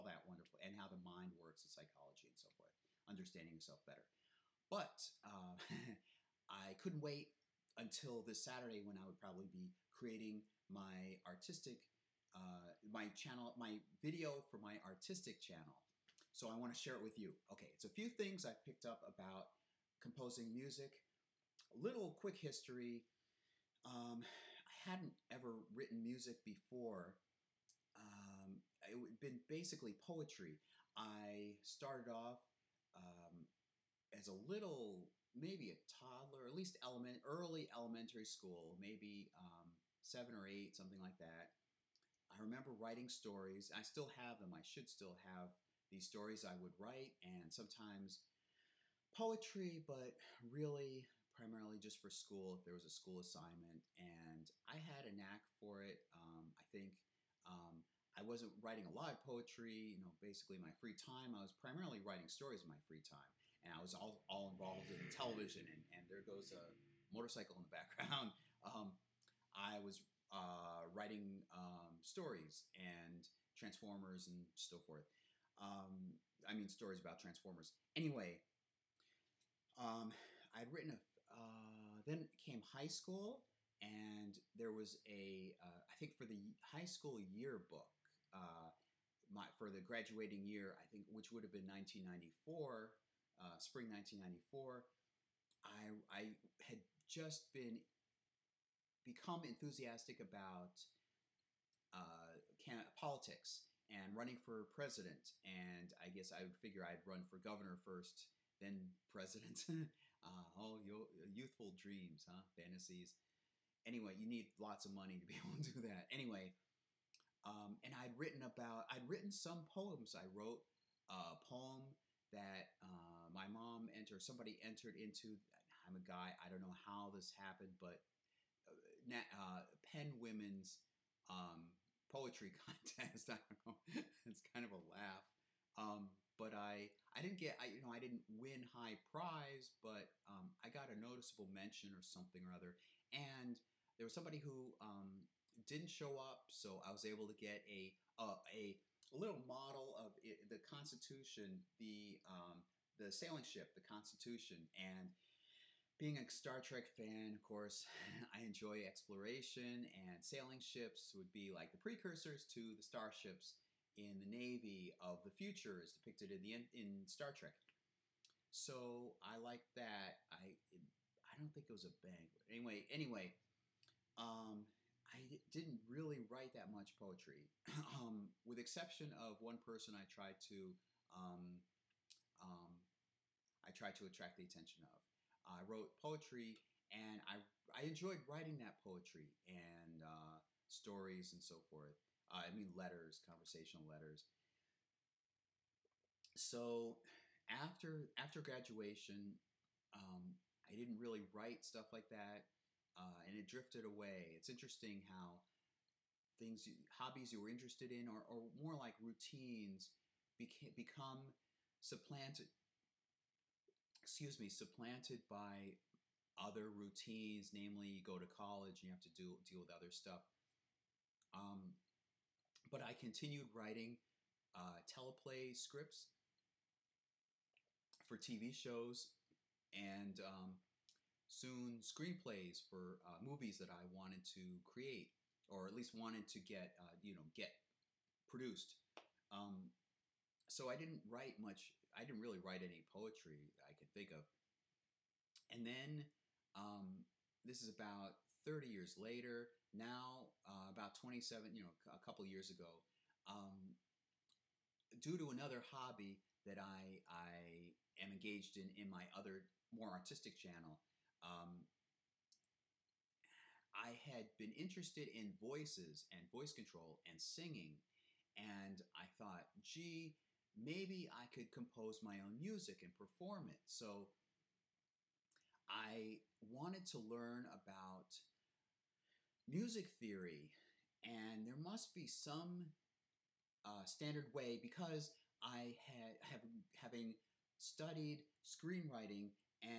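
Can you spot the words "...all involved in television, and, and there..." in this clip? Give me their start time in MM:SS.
01:04.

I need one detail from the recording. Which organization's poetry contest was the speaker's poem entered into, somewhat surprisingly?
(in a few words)
Pen Women.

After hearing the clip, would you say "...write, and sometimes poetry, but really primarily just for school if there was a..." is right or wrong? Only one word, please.
right.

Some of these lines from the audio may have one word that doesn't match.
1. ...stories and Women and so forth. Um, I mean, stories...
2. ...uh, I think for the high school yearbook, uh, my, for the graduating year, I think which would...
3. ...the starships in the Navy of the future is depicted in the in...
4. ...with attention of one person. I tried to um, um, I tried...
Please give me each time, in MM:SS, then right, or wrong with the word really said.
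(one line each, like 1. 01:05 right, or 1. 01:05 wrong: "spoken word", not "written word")
1. 01:12 wrong: "Transformers", not "Women"
2. 01:25 right
3. 02:42 right
4. 02:58 wrong: "exception", not "attention".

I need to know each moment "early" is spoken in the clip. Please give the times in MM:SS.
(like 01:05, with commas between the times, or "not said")
00:37.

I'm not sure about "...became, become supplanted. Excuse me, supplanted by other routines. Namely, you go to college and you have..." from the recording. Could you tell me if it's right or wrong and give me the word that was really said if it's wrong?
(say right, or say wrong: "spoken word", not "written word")
right.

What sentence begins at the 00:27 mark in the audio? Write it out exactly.
Um, it had been basically poetry.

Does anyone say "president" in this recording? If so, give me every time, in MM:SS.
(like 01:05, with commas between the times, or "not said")
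01:44, 01:49.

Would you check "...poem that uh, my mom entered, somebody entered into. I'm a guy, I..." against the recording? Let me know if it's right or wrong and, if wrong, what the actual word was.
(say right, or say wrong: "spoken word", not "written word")
right.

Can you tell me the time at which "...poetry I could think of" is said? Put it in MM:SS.
04:02.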